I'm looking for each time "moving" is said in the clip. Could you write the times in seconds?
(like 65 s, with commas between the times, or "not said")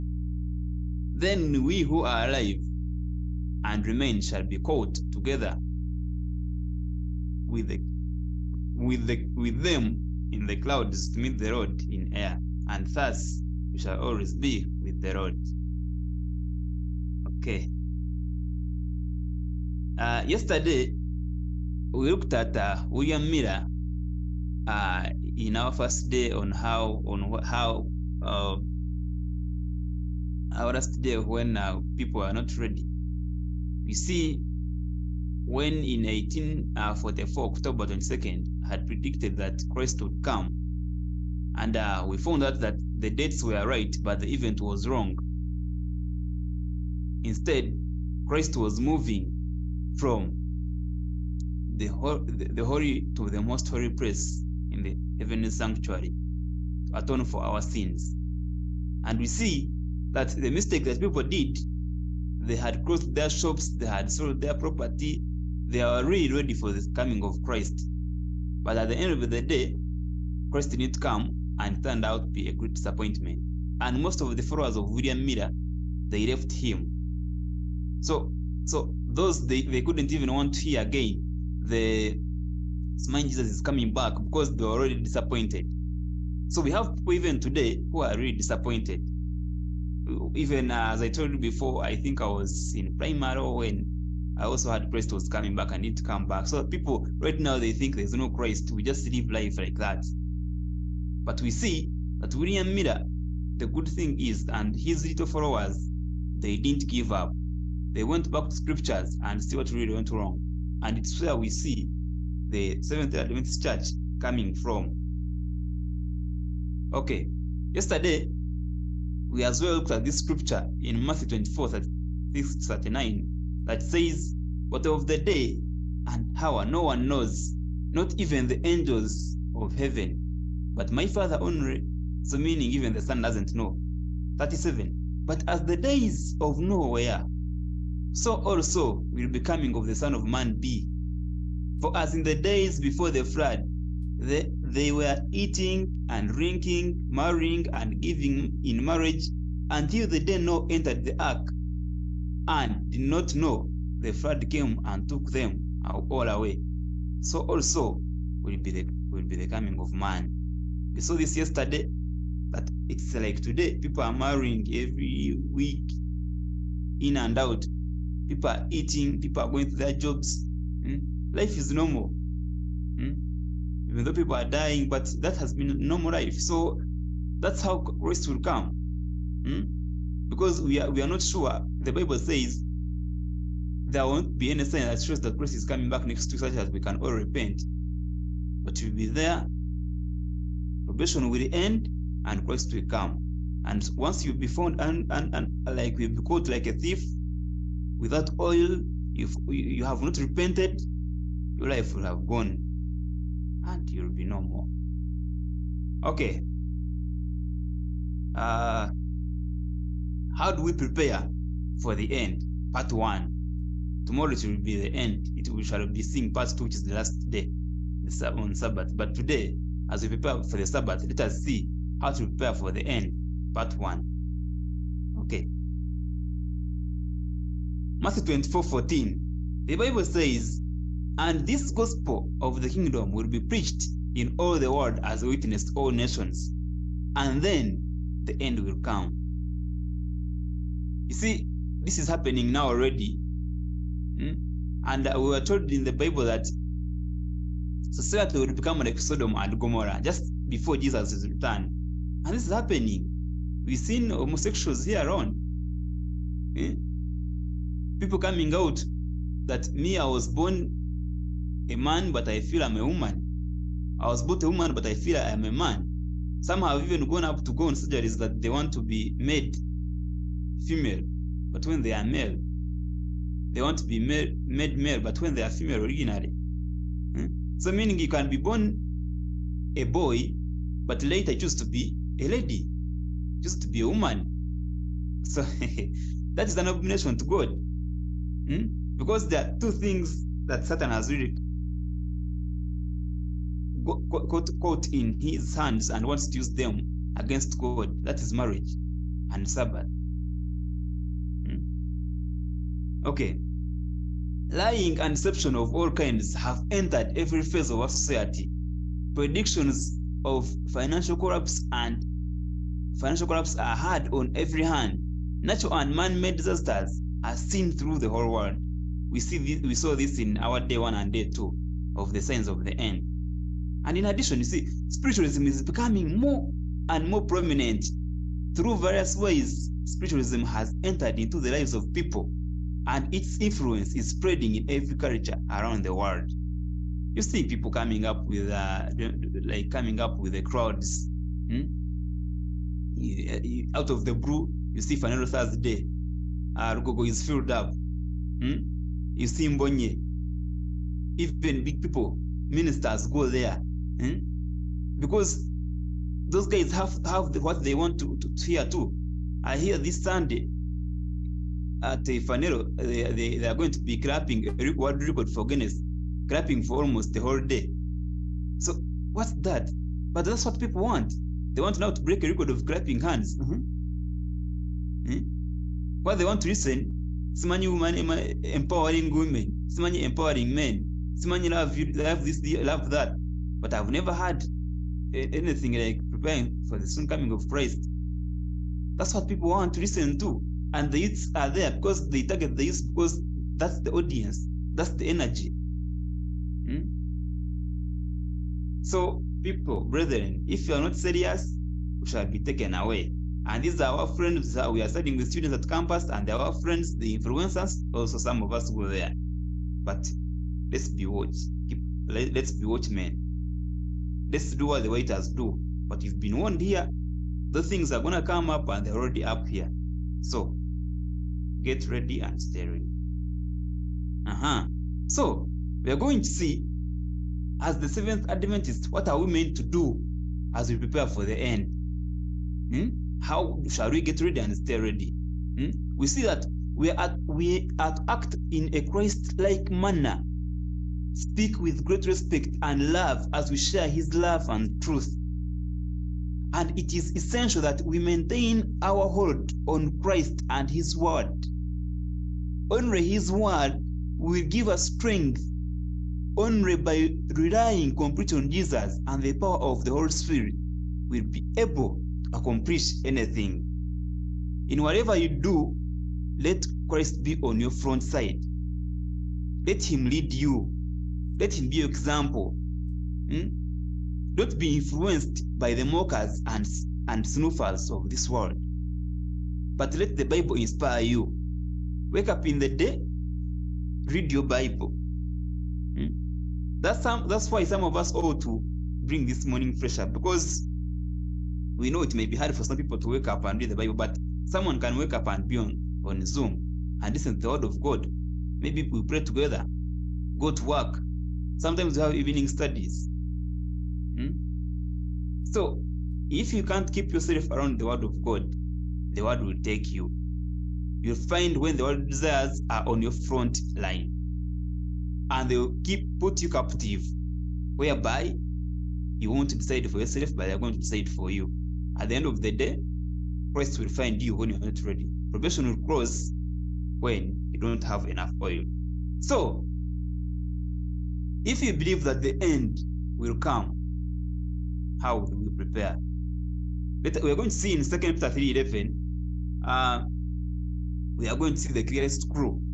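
48 s.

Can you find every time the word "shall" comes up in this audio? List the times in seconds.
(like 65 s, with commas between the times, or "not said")
4 s, 13 s, 215 s, 402 s, 433 s.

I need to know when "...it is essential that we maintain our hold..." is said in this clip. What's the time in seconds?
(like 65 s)
446 s.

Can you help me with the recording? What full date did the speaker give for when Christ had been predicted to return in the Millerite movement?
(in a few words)
October 22nd, 1844.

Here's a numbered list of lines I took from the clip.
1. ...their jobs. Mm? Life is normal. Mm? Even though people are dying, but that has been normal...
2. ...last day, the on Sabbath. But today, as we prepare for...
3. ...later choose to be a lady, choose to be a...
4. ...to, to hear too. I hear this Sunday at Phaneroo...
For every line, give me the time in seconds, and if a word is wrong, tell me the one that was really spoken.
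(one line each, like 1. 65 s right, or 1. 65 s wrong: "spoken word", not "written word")
1. 169 s right
2. 216 s right
3. 281 s right
4. 358 s right.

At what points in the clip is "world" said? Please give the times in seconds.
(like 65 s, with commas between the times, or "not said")
234 s, 318 s, 335 s, 364 s, 478 s.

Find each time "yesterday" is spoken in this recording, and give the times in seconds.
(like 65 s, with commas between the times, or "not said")
20 s, 117 s, 161 s.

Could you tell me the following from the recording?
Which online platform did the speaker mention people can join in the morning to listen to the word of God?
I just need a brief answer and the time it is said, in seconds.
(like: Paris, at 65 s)
Zoom, at 496 s.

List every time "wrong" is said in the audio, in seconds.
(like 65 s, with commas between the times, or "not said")
44 s, 110 s.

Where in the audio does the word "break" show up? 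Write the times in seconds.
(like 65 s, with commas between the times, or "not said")
372 s.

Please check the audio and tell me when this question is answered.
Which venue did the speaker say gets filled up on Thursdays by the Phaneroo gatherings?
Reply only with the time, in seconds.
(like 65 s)
346 s.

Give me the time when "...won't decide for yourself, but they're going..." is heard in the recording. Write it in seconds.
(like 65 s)
519 s.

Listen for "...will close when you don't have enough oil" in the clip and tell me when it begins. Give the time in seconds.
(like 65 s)
525 s.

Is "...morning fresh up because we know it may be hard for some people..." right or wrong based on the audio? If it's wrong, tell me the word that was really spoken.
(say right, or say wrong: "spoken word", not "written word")
right.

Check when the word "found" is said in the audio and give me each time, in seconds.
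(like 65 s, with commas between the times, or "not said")
42 s, 194 s.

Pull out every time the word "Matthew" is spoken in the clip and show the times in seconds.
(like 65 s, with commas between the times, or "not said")
121 s, 228 s.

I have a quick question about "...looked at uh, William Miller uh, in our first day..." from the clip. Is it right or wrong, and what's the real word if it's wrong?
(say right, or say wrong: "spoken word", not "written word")
right.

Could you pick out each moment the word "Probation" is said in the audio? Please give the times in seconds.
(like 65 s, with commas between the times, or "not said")
190 s, 525 s.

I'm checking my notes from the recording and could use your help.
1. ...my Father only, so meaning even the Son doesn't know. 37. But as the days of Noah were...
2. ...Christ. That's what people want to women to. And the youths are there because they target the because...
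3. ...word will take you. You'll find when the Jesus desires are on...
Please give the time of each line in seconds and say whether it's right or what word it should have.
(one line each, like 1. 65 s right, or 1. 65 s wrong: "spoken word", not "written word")
1. 130 s right
2. 387 s wrong: "listen", not "women"
3. 509 s wrong: "Word", not "Jesus".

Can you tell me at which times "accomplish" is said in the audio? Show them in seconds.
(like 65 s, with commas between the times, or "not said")
462 s.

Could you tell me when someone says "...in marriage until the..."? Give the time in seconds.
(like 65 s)
148 s.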